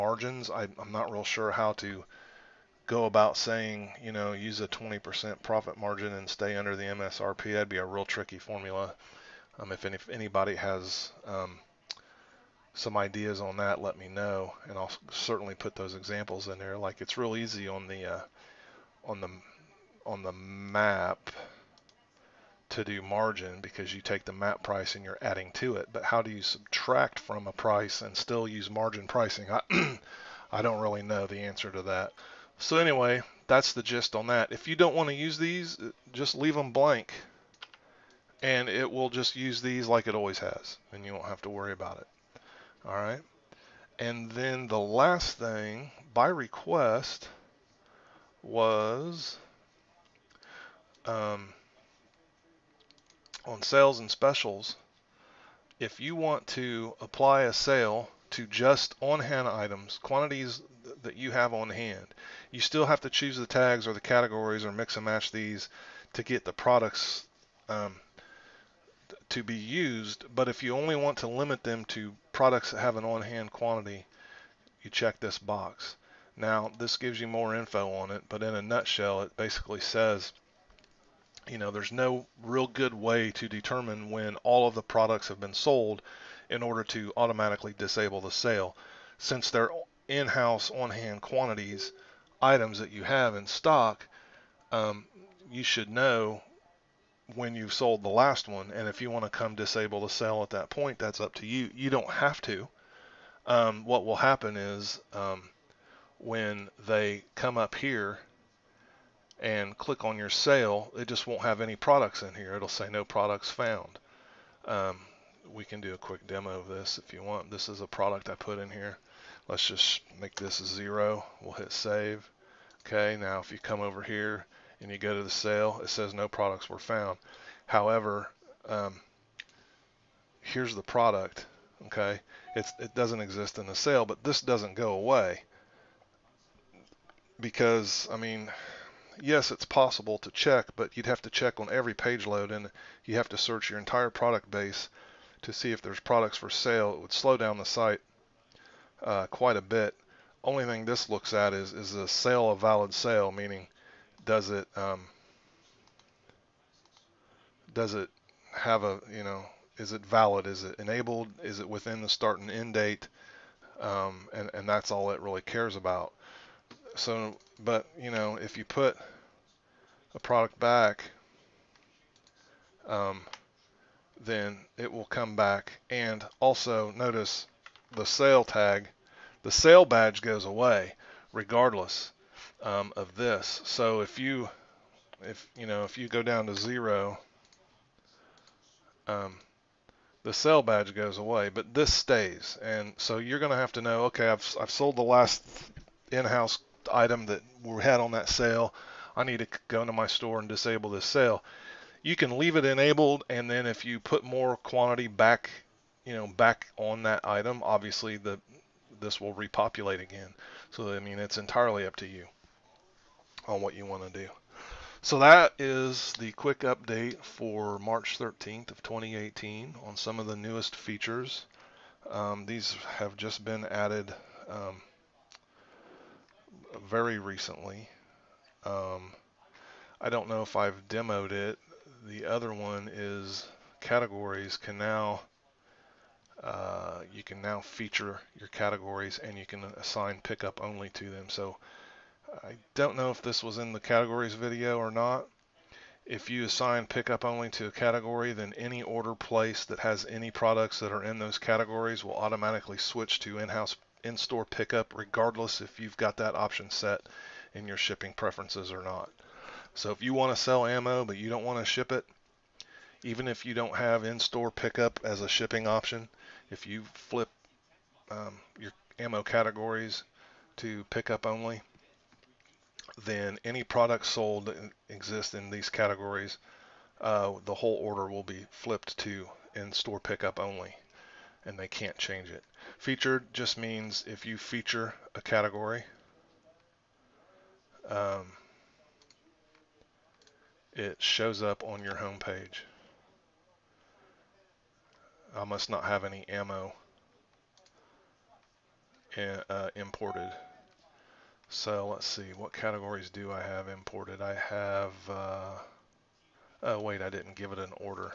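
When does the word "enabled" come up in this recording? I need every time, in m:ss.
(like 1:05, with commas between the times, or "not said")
2:40, 3:22.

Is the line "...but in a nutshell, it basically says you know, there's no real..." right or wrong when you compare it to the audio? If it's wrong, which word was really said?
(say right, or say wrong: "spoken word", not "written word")
right.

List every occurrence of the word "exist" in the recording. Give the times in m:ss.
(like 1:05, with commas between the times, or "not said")
2:13, 4:34.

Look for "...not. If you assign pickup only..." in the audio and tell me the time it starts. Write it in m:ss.
4:04.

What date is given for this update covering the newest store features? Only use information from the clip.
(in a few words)
March 13th, 2018.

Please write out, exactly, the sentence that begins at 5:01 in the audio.
So let's see, what categories do I have imported?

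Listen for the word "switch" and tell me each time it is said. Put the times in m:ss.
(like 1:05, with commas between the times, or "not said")
4:12.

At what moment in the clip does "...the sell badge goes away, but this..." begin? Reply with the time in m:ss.
3:10.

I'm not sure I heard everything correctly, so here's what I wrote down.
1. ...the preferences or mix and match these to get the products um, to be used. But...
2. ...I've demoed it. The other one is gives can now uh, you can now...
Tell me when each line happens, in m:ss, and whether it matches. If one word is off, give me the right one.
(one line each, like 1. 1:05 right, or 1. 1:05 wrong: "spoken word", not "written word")
1. 1:03 wrong: "categories", not "preferences"
2. 3:50 wrong: "categories", not "gives".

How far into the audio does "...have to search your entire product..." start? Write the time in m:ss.
2:23.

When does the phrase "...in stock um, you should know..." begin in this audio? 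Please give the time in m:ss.
1:33.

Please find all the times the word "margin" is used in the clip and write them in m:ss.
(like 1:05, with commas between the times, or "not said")
0:05, 0:23, 0:28.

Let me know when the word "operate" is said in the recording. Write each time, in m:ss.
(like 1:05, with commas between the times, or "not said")
not said.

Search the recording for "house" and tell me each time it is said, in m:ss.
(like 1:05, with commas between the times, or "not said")
1:30, 3:16, 4:13.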